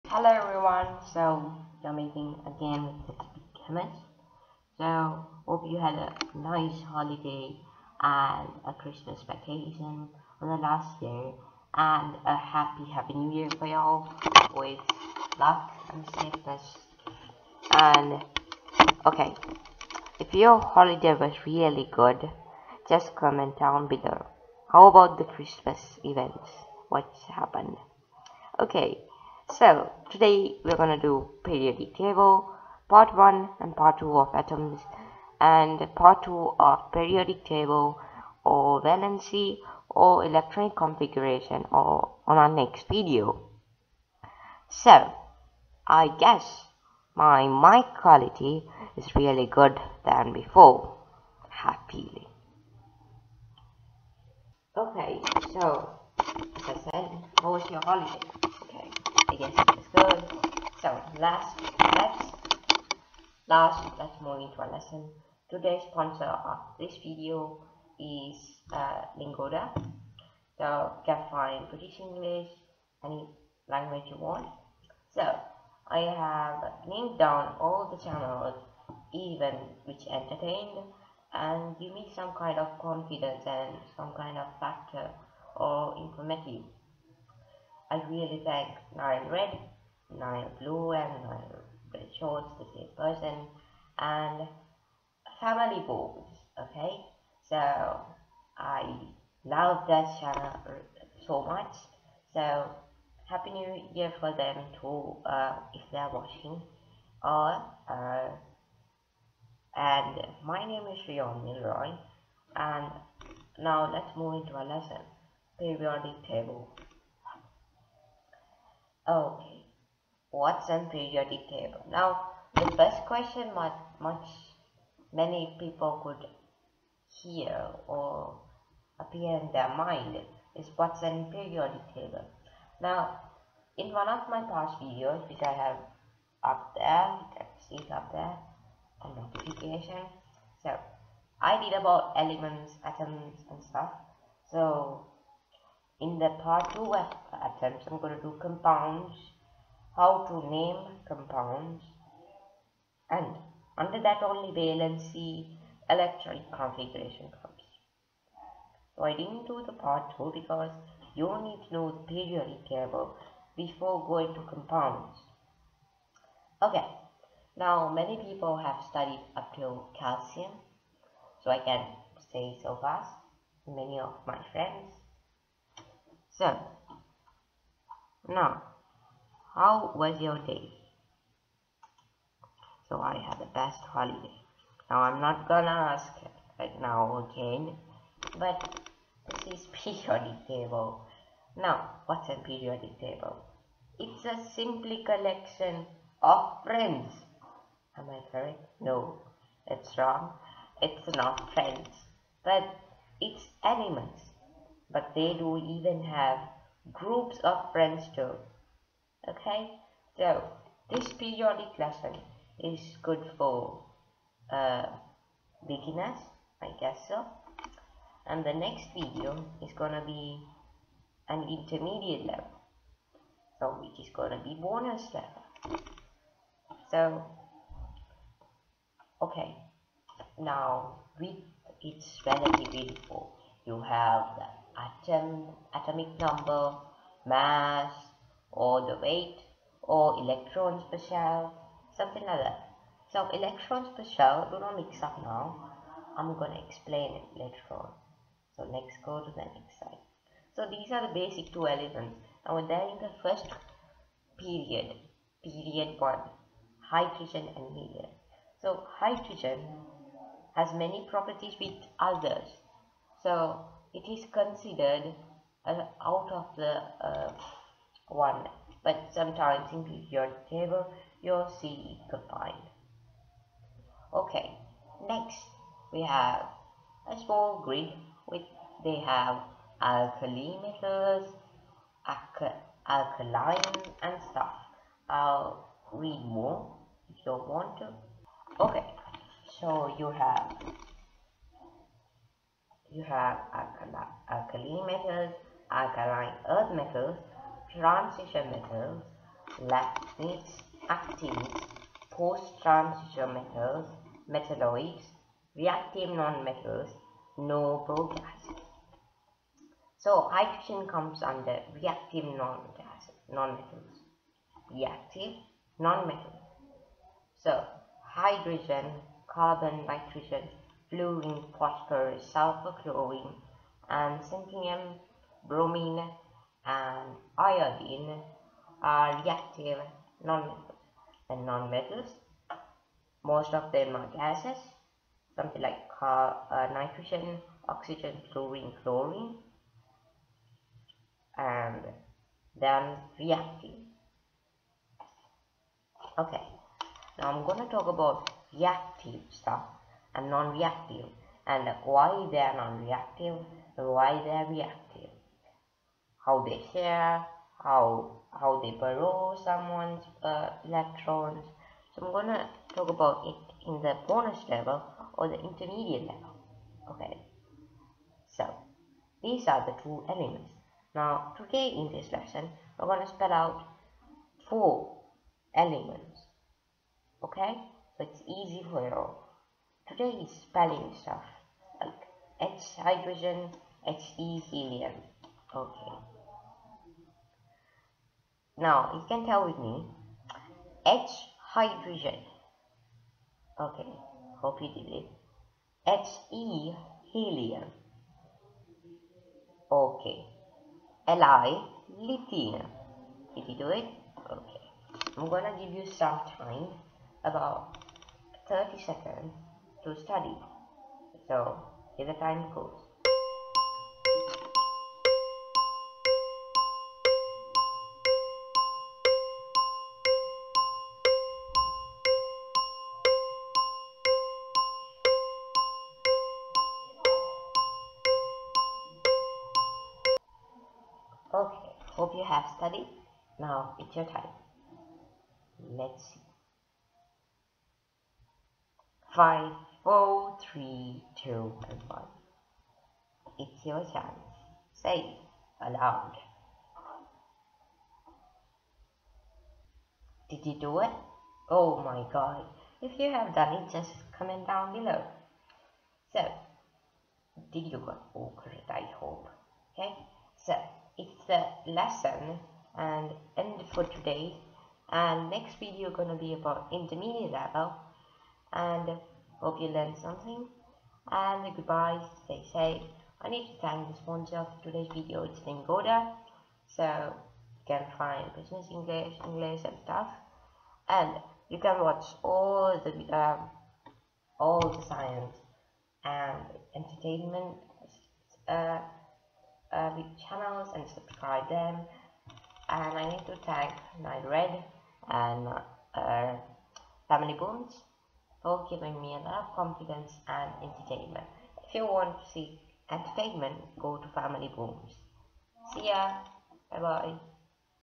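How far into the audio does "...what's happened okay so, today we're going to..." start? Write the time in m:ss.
0:26.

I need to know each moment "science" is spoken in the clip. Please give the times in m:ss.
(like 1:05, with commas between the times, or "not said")
8:04.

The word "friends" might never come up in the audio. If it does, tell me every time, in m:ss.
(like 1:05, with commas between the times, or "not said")
2:54, 3:16, 3:21, 3:27.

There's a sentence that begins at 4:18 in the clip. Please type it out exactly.
So hydrogen has many properties with others.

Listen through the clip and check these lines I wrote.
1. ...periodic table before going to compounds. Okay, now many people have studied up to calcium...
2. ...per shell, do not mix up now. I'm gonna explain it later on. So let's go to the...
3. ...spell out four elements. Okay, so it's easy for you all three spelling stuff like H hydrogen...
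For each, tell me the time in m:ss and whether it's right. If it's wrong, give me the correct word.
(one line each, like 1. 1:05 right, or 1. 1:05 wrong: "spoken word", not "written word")
1. 2:42 right
2. 4:03 right
3. 6:13 right.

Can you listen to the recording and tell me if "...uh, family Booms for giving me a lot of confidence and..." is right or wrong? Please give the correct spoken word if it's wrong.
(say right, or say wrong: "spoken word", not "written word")
right.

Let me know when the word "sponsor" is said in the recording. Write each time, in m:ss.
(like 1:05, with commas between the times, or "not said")
1:05, 7:54.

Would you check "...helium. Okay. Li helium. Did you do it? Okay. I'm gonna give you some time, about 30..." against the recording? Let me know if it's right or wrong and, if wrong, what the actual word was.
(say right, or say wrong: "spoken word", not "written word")
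wrong: "lithium", not "helium".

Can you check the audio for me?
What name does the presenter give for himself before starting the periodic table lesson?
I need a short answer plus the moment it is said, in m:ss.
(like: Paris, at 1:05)
Rion Milroy, at 1:51.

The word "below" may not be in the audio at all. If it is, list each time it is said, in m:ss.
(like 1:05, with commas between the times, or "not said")
0:23, 7:34.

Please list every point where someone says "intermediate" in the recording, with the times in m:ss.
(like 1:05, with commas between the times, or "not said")
3:41, 6:05, 7:46.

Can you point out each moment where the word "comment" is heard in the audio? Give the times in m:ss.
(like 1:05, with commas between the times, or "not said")
0:23, 7:34.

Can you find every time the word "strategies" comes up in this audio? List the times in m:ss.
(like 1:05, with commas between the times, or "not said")
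not said.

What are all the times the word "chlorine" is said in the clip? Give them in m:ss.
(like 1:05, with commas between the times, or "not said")
5:22, 5:38.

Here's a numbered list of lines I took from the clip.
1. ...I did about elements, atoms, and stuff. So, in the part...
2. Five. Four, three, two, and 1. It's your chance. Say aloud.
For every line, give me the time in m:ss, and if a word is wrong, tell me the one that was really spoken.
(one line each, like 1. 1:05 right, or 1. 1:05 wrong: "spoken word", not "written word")
1. 2:21 right
2. 7:19 right.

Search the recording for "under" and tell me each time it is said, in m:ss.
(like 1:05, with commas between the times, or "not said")
2:33, 5:11.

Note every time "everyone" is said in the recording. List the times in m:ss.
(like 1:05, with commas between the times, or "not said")
0:00.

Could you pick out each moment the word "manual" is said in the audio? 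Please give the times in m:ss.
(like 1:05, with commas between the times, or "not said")
not said.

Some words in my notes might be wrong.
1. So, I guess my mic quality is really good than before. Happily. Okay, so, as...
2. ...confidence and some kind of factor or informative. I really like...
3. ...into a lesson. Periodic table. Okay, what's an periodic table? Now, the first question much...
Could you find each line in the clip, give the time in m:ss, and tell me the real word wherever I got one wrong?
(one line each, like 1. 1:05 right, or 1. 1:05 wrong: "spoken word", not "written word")
1. 0:44 right
2. 1:22 right
3. 1:54 right.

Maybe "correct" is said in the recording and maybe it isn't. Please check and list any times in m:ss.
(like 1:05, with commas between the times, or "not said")
3:18, 7:38.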